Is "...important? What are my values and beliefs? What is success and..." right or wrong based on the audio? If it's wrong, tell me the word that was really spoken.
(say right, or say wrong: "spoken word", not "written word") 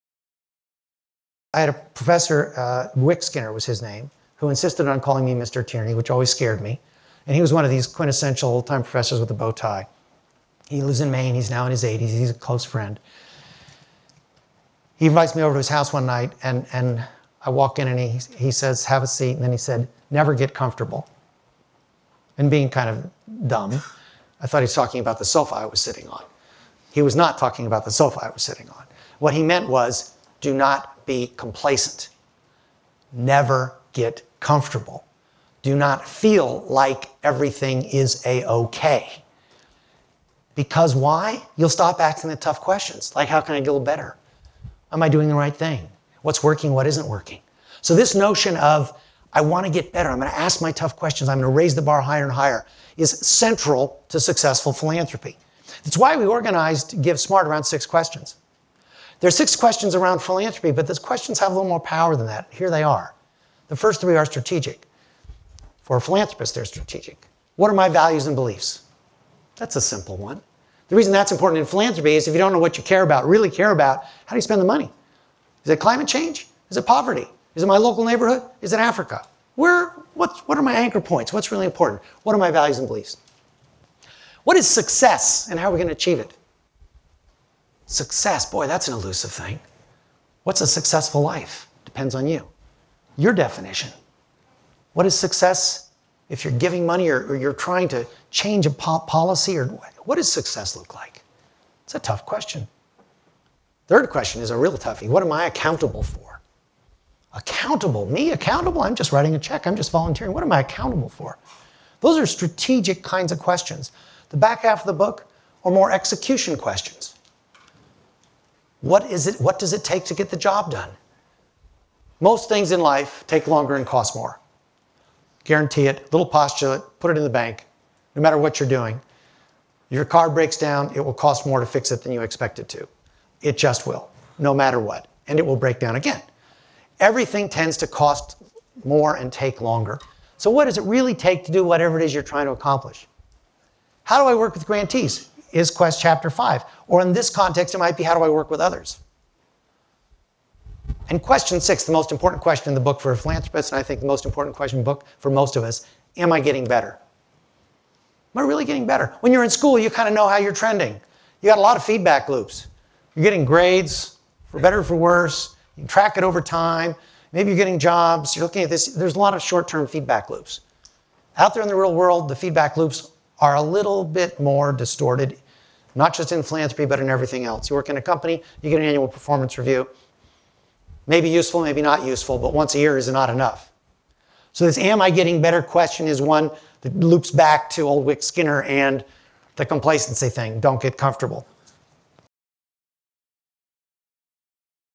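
right.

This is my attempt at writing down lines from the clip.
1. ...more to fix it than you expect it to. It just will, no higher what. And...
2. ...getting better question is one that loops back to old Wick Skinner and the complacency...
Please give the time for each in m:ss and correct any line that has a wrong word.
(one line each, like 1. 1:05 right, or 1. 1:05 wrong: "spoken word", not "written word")
1. 2:11 wrong: "matter", not "higher"
2. 3:05 right.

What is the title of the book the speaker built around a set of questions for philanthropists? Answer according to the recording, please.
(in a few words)
Give Smart.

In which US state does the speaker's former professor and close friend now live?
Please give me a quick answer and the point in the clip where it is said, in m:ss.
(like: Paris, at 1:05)
Maine, at 0:11.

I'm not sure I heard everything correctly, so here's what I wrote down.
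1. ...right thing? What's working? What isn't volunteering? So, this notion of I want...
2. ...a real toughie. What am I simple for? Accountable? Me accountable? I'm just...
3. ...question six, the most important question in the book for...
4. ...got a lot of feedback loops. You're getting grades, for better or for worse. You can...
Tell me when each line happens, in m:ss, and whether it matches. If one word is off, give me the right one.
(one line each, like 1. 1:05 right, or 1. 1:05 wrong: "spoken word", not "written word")
1. 0:45 wrong: "working", not "volunteering"
2. 1:44 wrong: "accountable", not "simple"
3. 2:31 right
4. 2:41 right.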